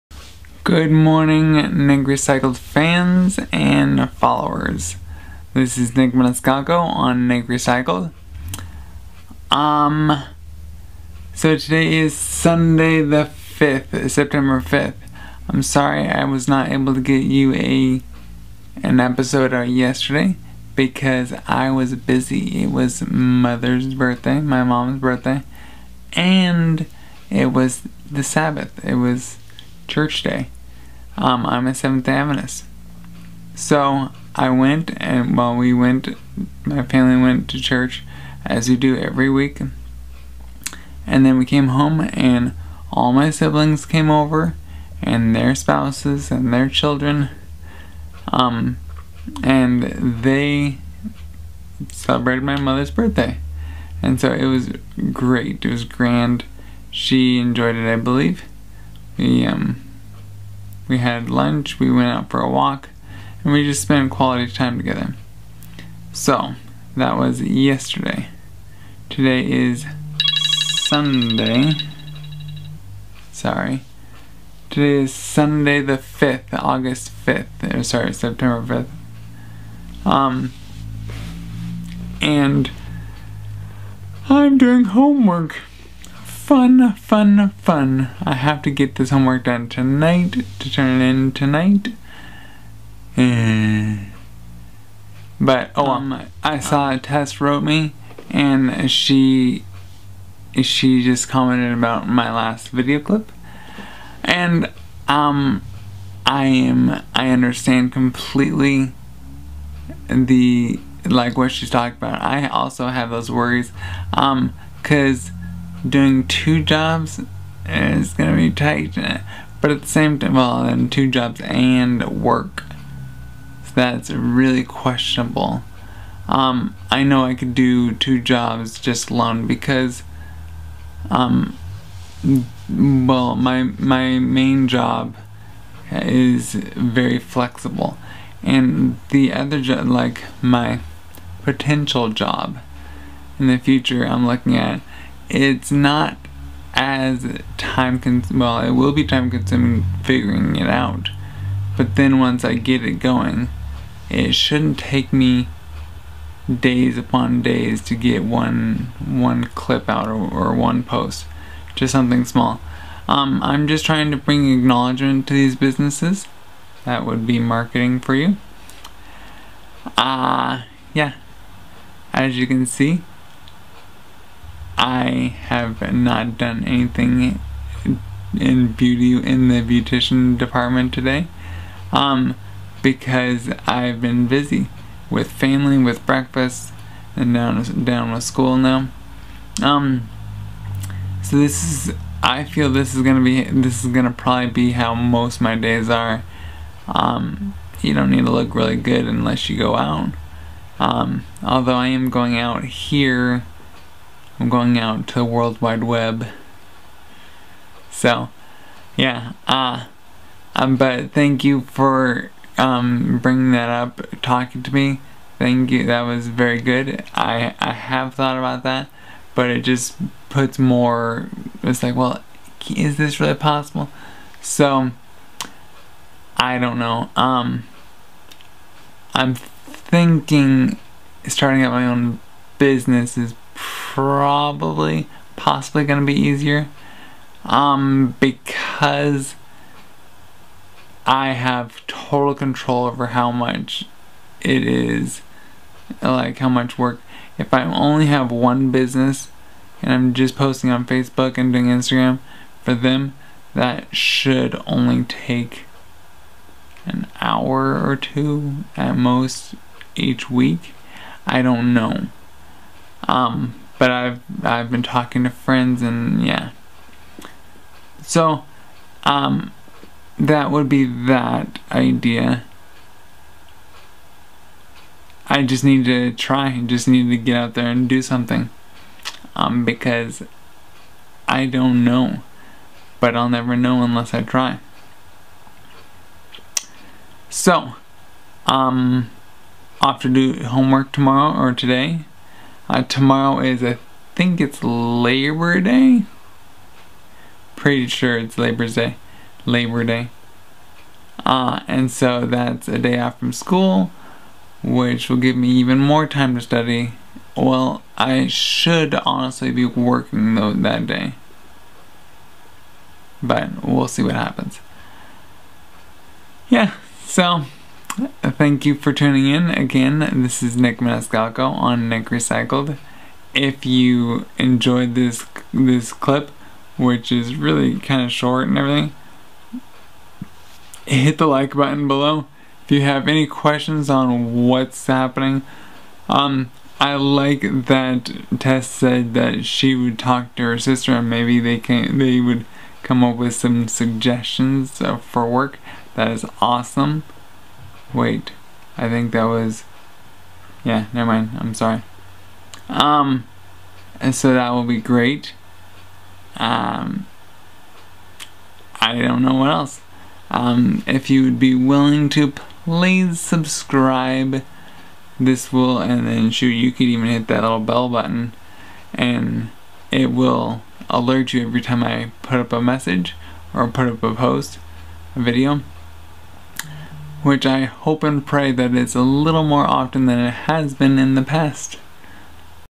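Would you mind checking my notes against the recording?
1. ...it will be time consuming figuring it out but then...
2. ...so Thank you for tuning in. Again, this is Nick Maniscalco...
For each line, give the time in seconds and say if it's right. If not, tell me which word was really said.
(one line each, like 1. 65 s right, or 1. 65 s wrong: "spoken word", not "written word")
1. 148 s right
2. 317 s right.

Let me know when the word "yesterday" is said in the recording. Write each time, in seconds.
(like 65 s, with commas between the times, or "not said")
19 s, 67 s.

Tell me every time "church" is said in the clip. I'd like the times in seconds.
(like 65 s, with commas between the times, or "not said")
29 s, 37 s.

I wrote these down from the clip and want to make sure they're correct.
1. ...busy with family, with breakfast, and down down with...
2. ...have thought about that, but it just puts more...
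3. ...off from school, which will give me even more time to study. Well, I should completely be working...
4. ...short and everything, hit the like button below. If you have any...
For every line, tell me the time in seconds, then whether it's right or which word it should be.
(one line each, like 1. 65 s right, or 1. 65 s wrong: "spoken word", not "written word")
1. 184 s right
2. 217 s right
3. 302 s wrong: "honestly", not "completely"
4. 328 s right.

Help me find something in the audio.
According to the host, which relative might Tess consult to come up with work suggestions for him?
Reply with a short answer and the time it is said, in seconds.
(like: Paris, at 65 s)
Her sister, at 340 s.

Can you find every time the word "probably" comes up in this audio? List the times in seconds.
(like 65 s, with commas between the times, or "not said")
194 s, 233 s.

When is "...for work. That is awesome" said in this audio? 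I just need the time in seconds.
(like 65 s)
344 s.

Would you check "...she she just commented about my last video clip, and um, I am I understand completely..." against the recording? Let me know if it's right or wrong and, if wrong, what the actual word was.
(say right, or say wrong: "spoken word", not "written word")
right.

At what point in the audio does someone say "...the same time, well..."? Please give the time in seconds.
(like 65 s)
119 s.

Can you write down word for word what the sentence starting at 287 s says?
So, um, off to do homework tomorrow or today uh, tomorrow is, I think it's Labor Day.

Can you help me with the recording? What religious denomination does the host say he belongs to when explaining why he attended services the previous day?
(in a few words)
Seventh day Adventist.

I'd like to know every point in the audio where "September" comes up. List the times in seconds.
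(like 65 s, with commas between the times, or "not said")
14 s, 78 s.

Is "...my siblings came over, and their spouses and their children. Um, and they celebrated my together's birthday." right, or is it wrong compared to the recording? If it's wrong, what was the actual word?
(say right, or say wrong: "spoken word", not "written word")
wrong: "mother", not "together".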